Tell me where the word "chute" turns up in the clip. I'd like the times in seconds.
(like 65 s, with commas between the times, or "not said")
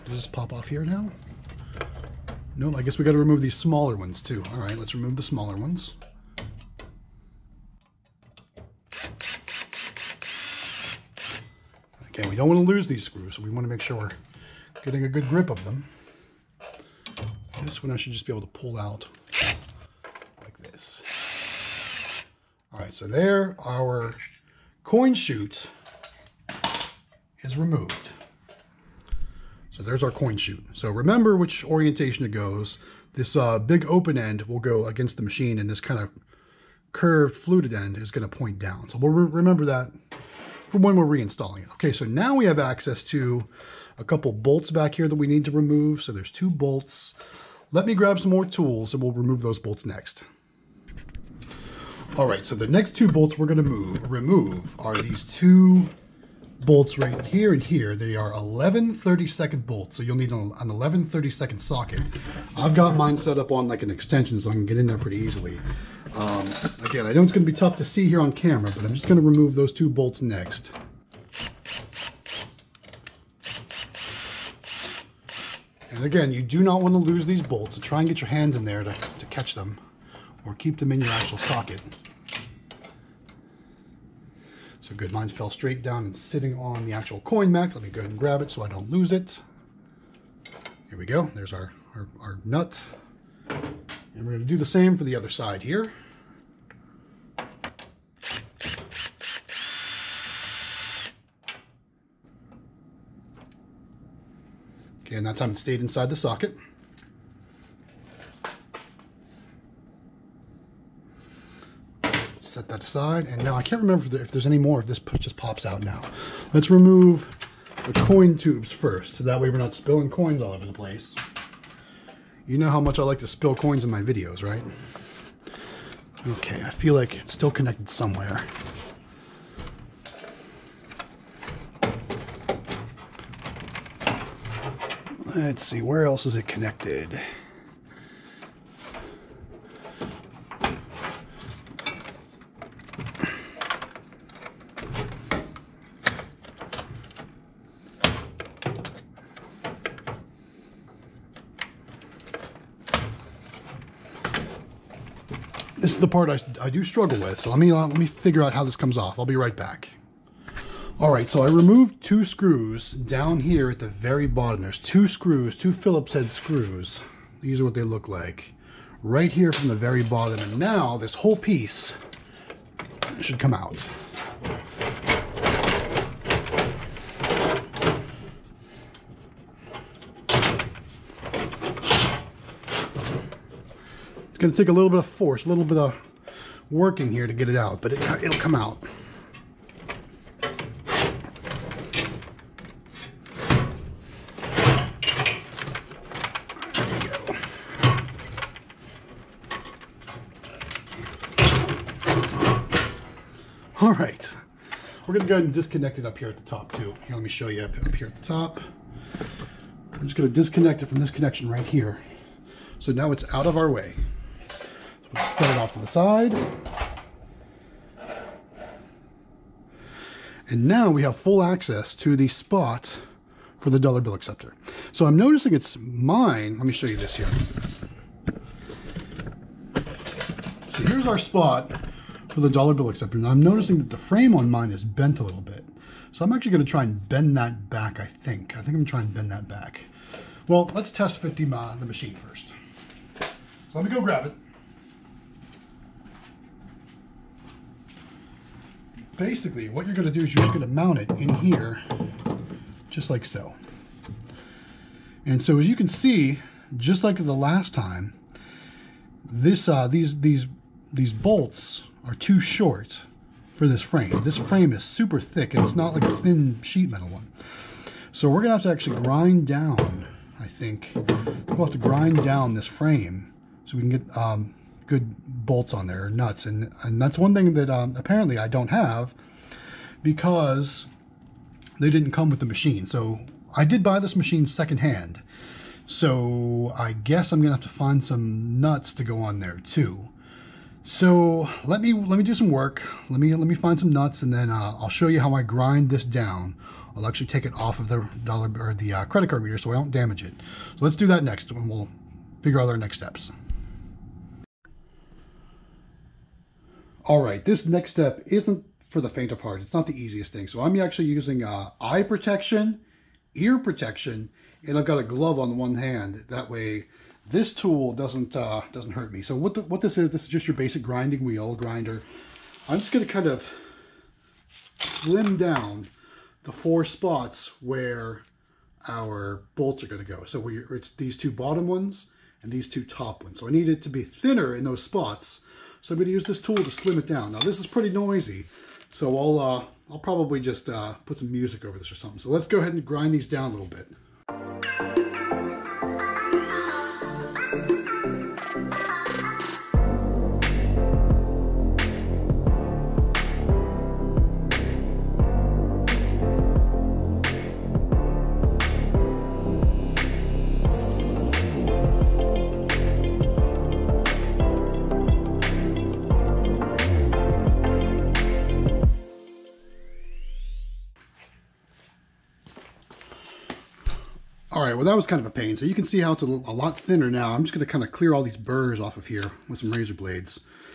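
25 s, 30 s.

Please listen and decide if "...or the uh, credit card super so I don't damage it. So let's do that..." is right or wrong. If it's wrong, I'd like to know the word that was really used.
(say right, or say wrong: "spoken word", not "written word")
wrong: "reader", not "super".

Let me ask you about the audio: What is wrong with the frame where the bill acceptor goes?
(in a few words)
bent.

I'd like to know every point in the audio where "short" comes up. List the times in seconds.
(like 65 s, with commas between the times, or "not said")
262 s.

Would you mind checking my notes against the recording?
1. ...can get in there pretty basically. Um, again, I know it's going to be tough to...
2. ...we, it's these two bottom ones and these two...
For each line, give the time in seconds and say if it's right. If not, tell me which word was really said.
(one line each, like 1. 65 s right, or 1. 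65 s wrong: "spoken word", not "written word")
1. 64 s wrong: "easily", not "basically"
2. 330 s right.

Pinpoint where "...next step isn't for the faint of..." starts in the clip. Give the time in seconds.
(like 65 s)
307 s.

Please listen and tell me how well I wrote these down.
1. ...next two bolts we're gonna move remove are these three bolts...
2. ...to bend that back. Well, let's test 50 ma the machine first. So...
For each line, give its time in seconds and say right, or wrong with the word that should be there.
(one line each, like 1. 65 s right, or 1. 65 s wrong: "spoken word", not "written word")
1. 52 s wrong: "two", not "three"
2. 239 s right.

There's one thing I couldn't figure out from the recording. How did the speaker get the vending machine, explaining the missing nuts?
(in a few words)
secondhand.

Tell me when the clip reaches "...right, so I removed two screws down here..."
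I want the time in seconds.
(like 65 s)
161 s.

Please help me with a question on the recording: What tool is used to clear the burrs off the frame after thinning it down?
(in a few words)
razor blades.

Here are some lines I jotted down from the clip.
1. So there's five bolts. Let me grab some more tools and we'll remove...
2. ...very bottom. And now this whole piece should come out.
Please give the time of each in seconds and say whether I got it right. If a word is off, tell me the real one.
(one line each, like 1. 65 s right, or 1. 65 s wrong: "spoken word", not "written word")
1. 46 s wrong: "two", not "five"
2. 169 s right.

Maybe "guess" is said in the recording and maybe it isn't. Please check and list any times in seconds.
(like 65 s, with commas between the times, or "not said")
2 s, 286 s.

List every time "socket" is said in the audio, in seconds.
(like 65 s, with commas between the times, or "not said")
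61 s, 81 s, 106 s.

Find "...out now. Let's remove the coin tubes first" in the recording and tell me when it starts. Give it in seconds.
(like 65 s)
115 s.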